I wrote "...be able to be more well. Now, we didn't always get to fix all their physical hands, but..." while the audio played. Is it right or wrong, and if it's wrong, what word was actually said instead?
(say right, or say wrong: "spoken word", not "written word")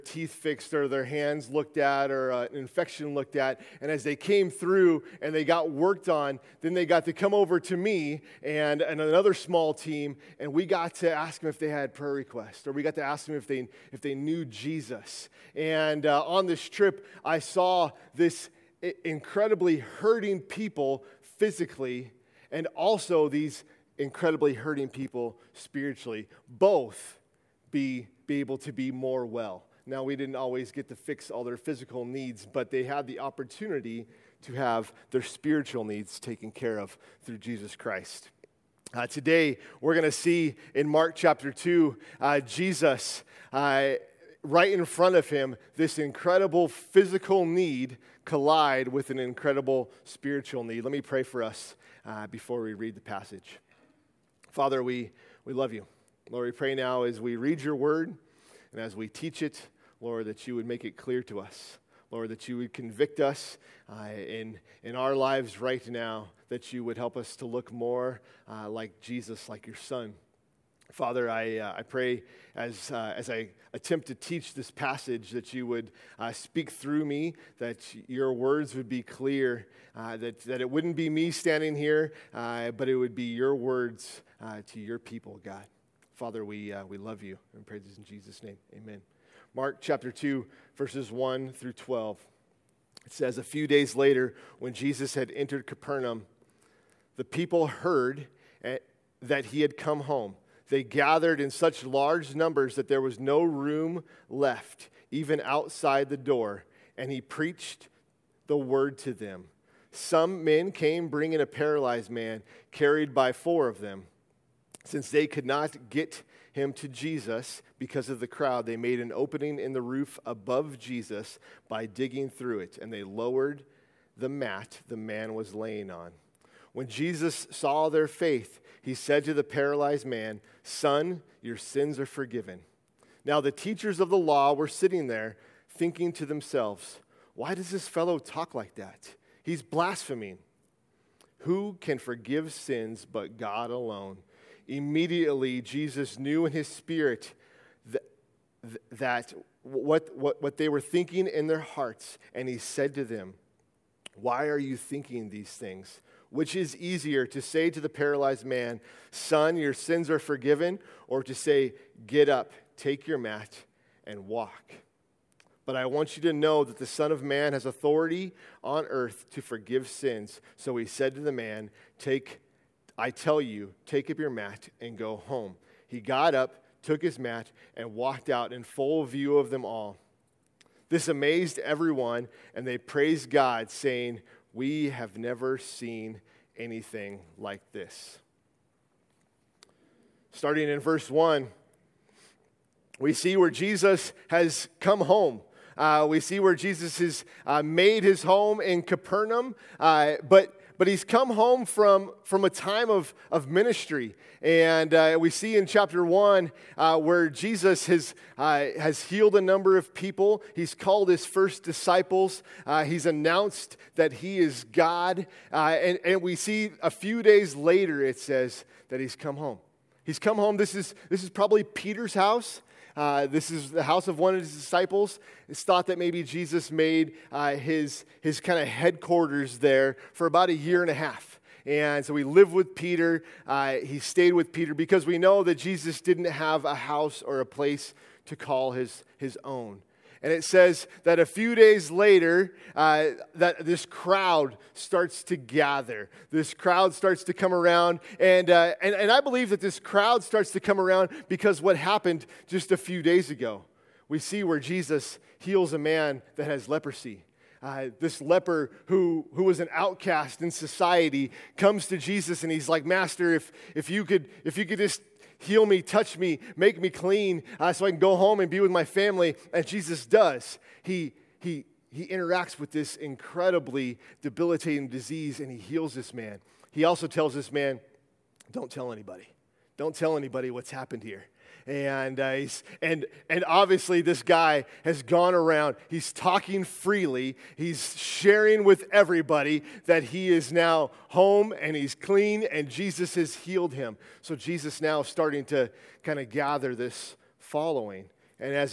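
wrong: "needs", not "hands".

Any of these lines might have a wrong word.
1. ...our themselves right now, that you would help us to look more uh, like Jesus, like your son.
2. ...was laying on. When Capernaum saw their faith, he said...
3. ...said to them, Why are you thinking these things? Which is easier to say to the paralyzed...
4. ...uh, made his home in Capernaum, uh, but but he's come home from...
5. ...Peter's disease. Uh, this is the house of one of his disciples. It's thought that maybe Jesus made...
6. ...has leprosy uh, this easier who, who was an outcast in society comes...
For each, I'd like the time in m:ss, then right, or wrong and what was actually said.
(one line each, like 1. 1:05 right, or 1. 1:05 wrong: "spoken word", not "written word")
1. 1:04 wrong: "lives", not "themselves"
2. 2:05 wrong: "Jesus", not "Capernaum"
3. 2:32 right
4. 3:17 right
5. 3:41 wrong: "house", not "disease"
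6. 4:16 wrong: "leper", not "easier".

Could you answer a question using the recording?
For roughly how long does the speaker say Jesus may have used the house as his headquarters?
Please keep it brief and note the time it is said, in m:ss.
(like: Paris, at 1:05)
A year and a half, at 3:50.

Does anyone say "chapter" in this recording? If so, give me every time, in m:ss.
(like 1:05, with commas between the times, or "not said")
0:41, 1:29, 3:25.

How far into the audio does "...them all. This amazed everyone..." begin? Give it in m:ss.
2:59.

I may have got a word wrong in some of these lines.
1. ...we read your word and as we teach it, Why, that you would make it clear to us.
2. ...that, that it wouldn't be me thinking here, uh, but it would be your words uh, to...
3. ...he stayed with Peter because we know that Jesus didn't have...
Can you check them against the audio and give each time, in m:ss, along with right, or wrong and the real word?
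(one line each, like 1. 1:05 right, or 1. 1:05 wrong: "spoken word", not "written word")
1. 0:57 wrong: "Lord", not "Why"
2. 1:20 wrong: "standing", not "thinking"
3. 3:53 right.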